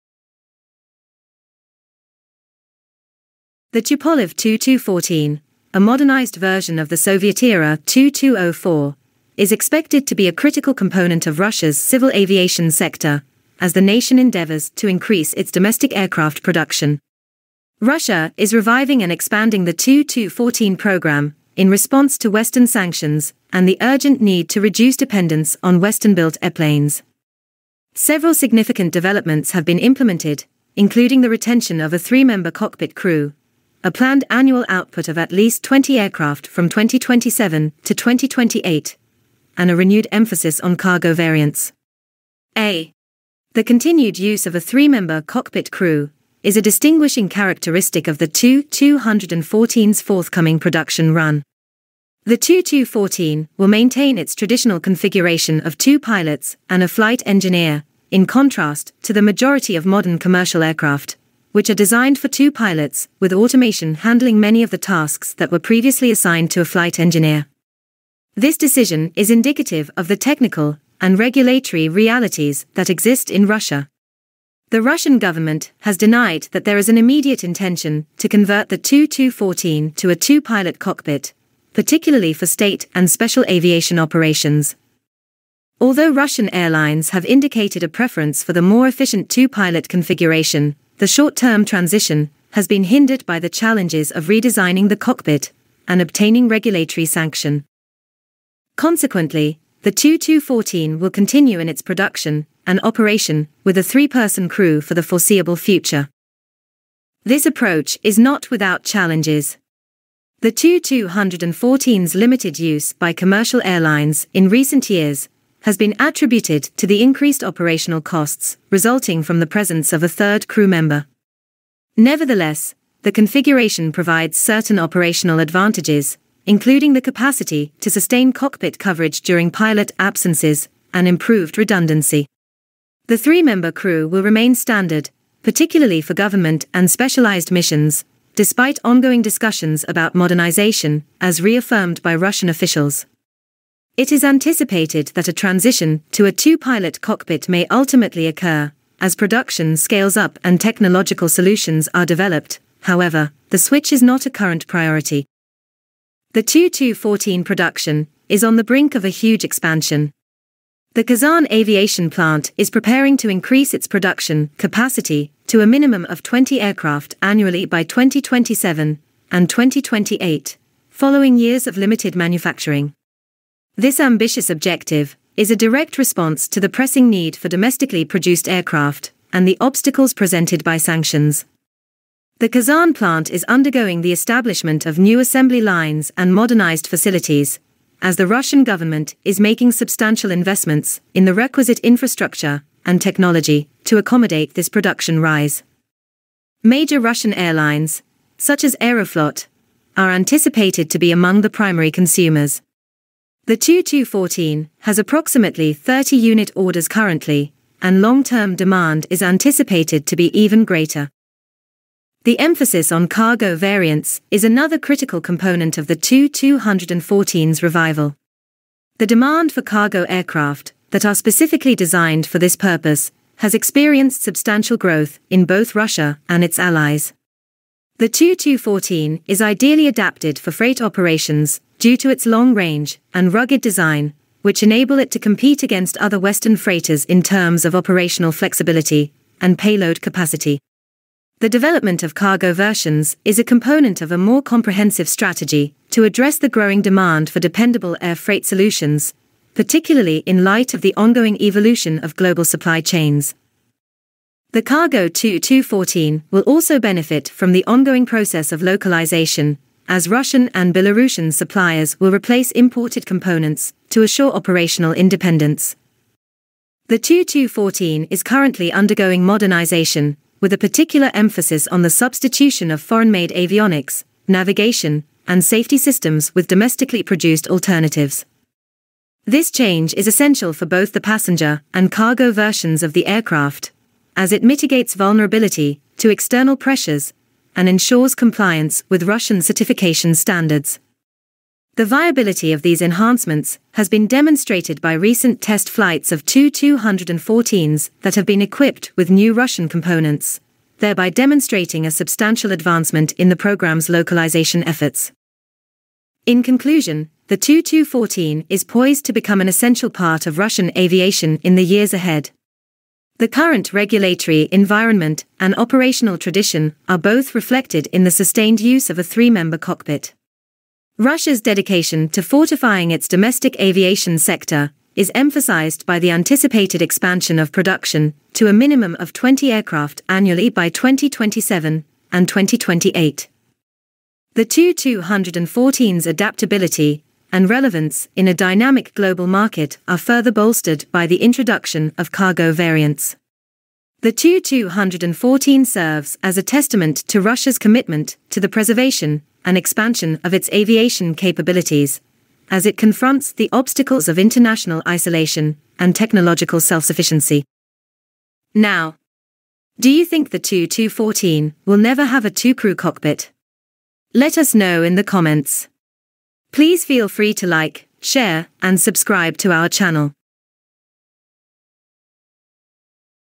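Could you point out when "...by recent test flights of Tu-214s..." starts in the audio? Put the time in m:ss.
4:54.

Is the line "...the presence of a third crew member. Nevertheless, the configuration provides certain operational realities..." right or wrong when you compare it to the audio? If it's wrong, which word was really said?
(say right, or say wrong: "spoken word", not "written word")
wrong: "advantages", not "realities".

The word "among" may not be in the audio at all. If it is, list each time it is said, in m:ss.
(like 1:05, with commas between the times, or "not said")
3:21.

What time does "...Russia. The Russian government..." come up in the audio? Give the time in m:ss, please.
1:13.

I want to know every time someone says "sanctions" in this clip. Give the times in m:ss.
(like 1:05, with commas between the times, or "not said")
0:22, 1:37, 3:00.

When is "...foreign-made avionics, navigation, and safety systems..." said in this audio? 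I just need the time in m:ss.
4:32.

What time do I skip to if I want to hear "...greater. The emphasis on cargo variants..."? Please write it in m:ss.
3:30.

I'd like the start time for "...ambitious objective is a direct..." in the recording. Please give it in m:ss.
2:54.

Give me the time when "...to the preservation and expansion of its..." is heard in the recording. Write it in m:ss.
5:48.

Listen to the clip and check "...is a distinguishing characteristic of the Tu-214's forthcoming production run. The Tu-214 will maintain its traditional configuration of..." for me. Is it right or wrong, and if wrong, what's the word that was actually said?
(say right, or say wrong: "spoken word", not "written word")
right.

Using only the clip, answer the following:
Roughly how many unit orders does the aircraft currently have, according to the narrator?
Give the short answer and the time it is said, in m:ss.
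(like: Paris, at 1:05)
30, at 3:25.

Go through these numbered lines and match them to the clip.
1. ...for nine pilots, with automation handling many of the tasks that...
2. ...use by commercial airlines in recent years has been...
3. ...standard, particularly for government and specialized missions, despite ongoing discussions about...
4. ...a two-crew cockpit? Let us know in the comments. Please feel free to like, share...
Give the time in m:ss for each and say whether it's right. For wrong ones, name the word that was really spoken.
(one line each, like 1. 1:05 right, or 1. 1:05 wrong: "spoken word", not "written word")
1. 1:02 wrong: "two", not "nine"
2. 1:52 right
3. 2:14 right
4. 6:02 right.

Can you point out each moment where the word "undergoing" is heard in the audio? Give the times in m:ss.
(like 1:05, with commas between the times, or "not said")
3:03, 4:28.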